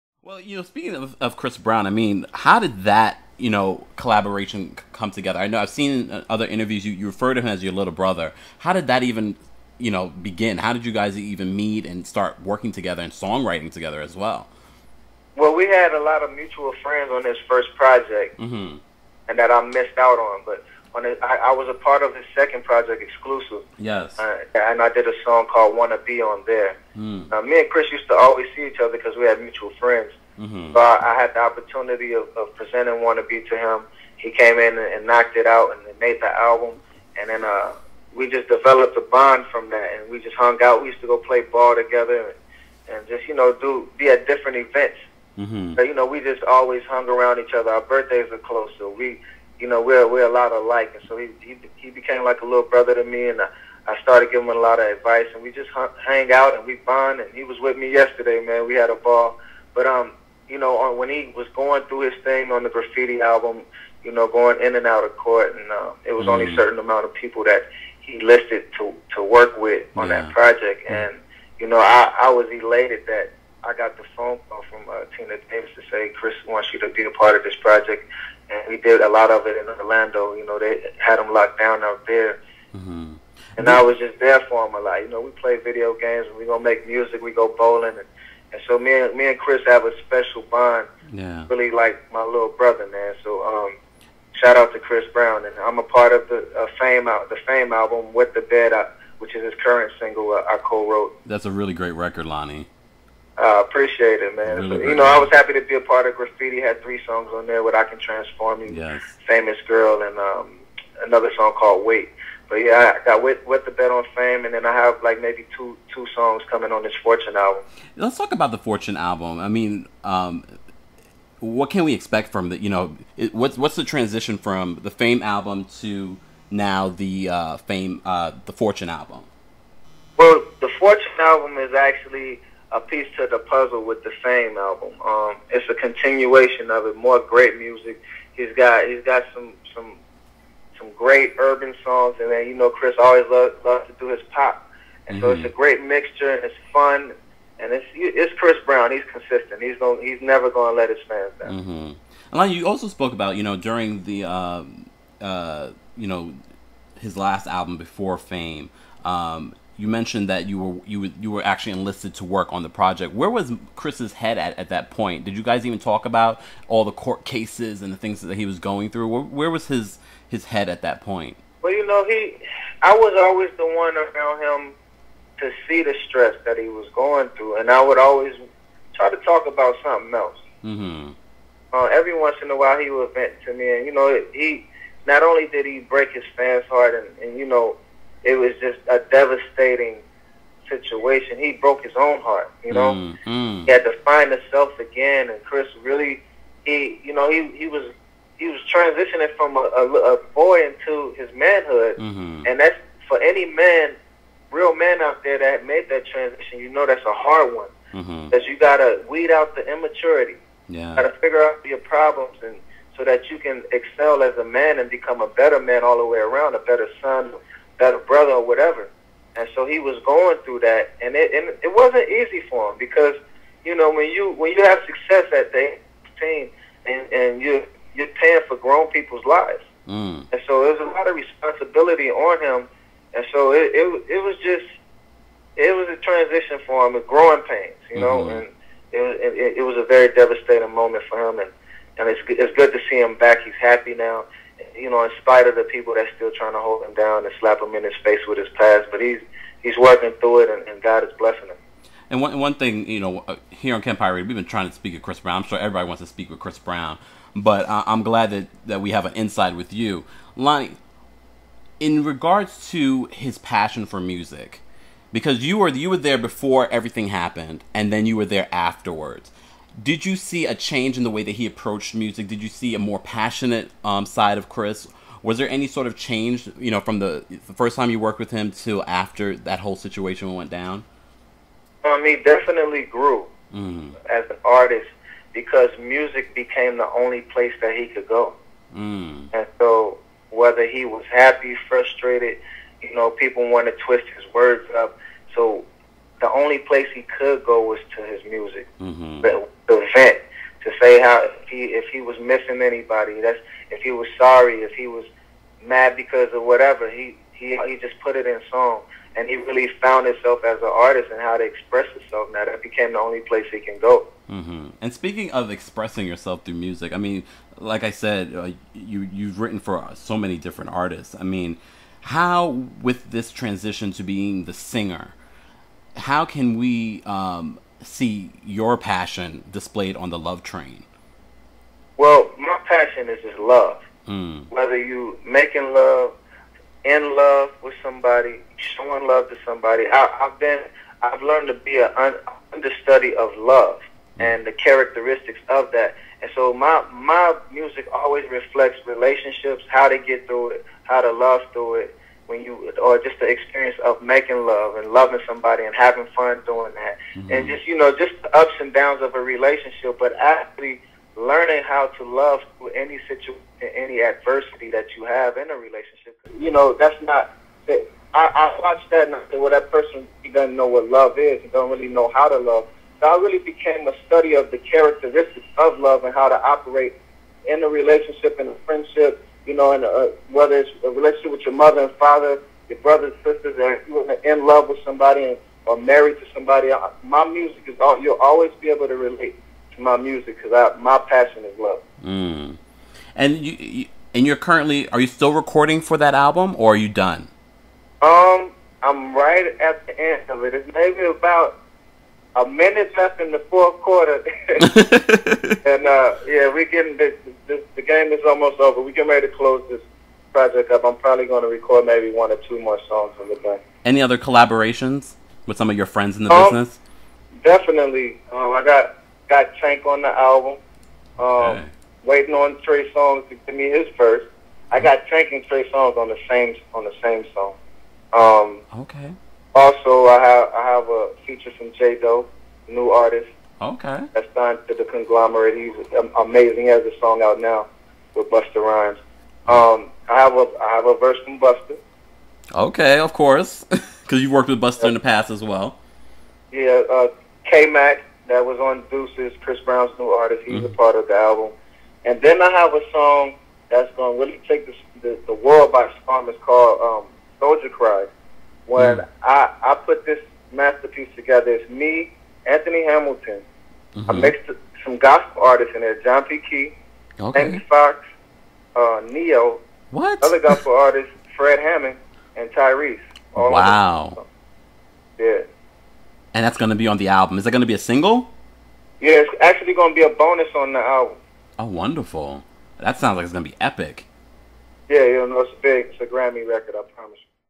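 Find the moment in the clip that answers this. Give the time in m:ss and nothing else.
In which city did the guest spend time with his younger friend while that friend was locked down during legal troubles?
1:19.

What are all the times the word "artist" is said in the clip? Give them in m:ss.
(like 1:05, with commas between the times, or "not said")
4:44, 5:10, 5:20, 7:12, 7:30, 7:45, 7:50.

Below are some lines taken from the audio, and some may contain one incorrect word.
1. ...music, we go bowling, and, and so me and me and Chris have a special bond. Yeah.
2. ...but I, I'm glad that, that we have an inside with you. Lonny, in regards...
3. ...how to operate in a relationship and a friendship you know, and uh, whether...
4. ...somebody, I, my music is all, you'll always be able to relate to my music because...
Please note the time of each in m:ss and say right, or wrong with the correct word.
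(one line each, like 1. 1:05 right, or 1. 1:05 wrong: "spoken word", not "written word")
1. 1:26 right
2. 4:17 right
3. 6:16 right
4. 6:26 right.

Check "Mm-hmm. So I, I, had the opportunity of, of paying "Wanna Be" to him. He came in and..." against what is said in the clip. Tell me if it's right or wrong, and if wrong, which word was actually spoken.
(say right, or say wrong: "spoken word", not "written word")
wrong: "presenting", not "paying".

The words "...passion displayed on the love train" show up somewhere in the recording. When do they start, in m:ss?
5:28.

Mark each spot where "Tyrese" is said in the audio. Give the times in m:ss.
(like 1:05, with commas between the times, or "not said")
7:52.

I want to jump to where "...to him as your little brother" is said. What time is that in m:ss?
0:07.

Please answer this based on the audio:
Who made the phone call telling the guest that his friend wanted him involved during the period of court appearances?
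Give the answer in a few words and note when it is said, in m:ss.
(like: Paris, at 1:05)
Tina Davis, at 1:15.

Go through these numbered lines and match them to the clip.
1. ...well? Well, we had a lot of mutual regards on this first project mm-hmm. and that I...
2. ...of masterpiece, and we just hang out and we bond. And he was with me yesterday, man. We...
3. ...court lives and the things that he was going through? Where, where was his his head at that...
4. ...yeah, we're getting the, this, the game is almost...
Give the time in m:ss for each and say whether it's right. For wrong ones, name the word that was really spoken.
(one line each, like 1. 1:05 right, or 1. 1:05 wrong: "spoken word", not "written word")
1. 0:14 wrong: "friends", not "regards"
2. 0:54 wrong: "advice", not "masterpiece"
3. 2:46 wrong: "cases", not "lives"
4. 6:46 right.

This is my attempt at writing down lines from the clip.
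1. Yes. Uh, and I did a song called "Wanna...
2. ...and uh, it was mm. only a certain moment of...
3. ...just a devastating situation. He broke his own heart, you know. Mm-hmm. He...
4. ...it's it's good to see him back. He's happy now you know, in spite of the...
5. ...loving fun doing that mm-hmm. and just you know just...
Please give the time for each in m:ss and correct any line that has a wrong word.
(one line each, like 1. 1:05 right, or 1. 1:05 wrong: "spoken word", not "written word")
1. 0:23 right
2. 1:05 wrong: "amount", not "moment"
3. 3:08 right
4. 4:02 right
5. 5:55 wrong: "having", not "loving".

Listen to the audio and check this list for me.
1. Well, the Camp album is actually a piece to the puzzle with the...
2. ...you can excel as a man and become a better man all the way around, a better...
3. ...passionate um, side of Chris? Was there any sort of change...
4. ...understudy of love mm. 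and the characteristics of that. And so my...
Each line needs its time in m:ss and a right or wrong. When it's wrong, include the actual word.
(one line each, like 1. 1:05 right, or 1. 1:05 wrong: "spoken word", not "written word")
1. 2:10 wrong: "Fortune", not "Camp"
2. 3:33 right
3. 4:32 right
4. 5:42 right.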